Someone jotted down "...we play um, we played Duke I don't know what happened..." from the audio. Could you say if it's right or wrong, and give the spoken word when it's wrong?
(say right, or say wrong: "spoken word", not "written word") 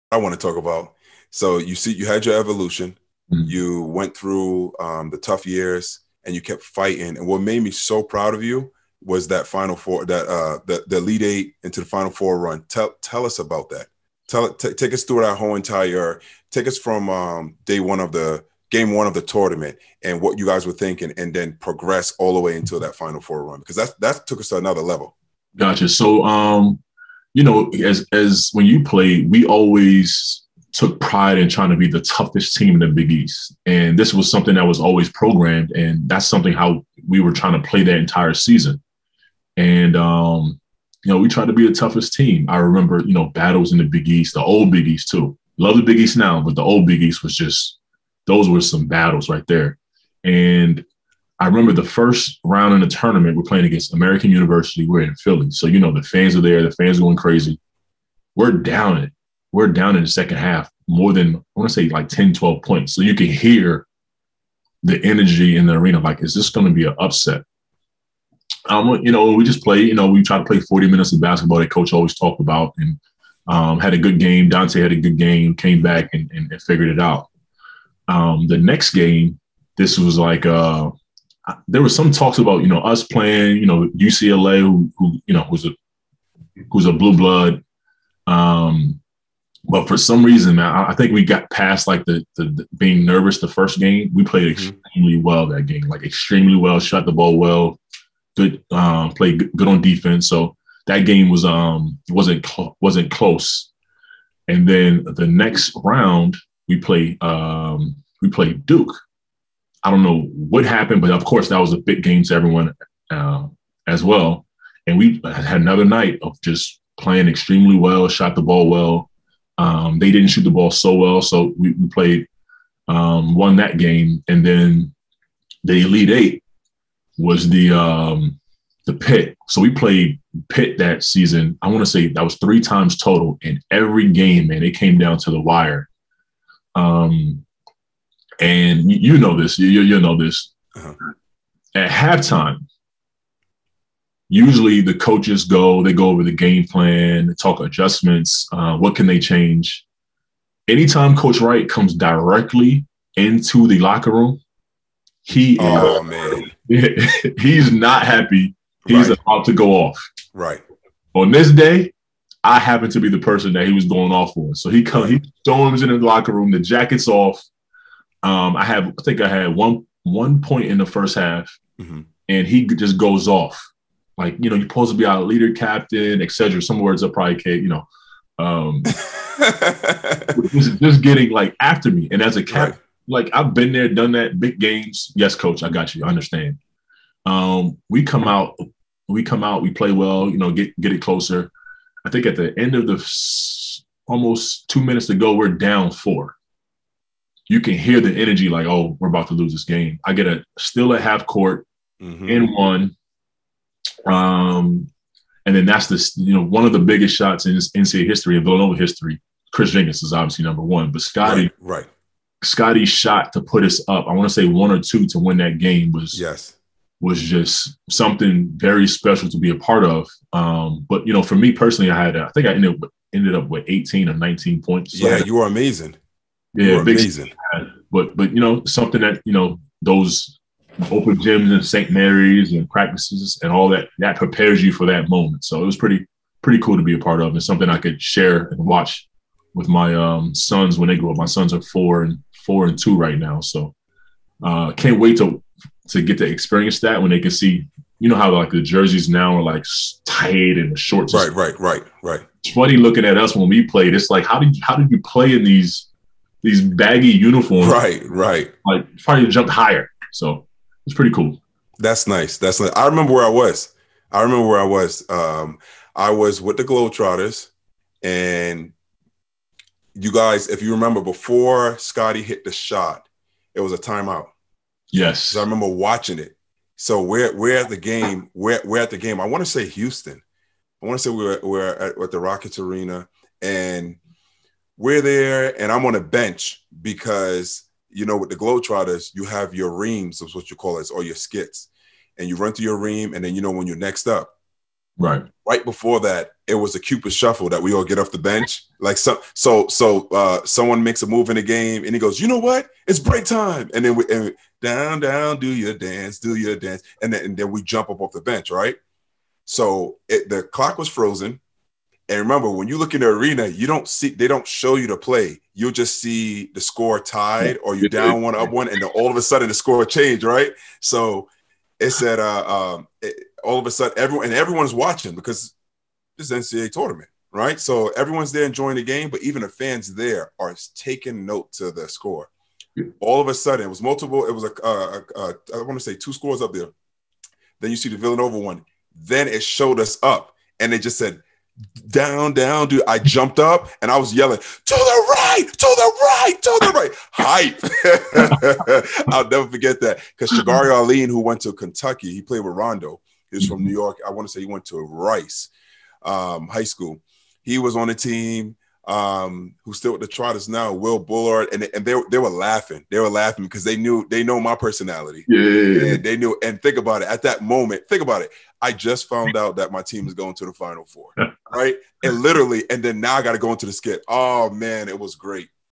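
right.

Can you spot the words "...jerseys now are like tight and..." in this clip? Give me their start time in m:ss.
4:08.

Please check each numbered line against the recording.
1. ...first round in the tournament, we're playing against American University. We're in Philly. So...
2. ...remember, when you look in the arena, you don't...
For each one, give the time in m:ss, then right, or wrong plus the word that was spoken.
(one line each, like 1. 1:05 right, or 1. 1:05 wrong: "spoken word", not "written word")
1. 0:51 right
2. 5:12 right.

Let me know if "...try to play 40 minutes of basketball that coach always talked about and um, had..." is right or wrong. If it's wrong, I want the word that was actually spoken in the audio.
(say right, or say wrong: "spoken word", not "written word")
right.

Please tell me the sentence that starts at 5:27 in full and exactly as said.
So everyone's there enjoying the game, but even the fans there are taking note to the score.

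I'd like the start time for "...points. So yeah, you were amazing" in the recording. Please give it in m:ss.
3:44.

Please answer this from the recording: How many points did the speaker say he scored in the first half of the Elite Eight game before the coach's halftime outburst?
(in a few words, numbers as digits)
1.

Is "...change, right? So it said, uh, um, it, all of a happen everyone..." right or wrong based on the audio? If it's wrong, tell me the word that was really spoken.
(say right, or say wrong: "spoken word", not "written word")
wrong: "sudden", not "happen".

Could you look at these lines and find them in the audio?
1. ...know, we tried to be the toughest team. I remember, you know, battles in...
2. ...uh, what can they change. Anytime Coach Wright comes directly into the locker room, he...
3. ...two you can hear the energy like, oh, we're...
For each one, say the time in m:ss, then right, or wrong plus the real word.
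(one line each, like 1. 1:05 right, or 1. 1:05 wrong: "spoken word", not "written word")
1. 0:41 right
2. 2:28 right
3. 3:15 wrong: "four", not "two".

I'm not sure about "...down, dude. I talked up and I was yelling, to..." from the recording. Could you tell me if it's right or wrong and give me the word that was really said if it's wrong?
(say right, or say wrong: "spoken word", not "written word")
wrong: "jumped", not "talked".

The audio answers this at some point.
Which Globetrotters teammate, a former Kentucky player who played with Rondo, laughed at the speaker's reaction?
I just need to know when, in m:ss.
5:50.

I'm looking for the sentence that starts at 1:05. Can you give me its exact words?
Like, is this going to be an upset?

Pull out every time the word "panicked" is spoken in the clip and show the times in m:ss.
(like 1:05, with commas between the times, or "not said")
not said.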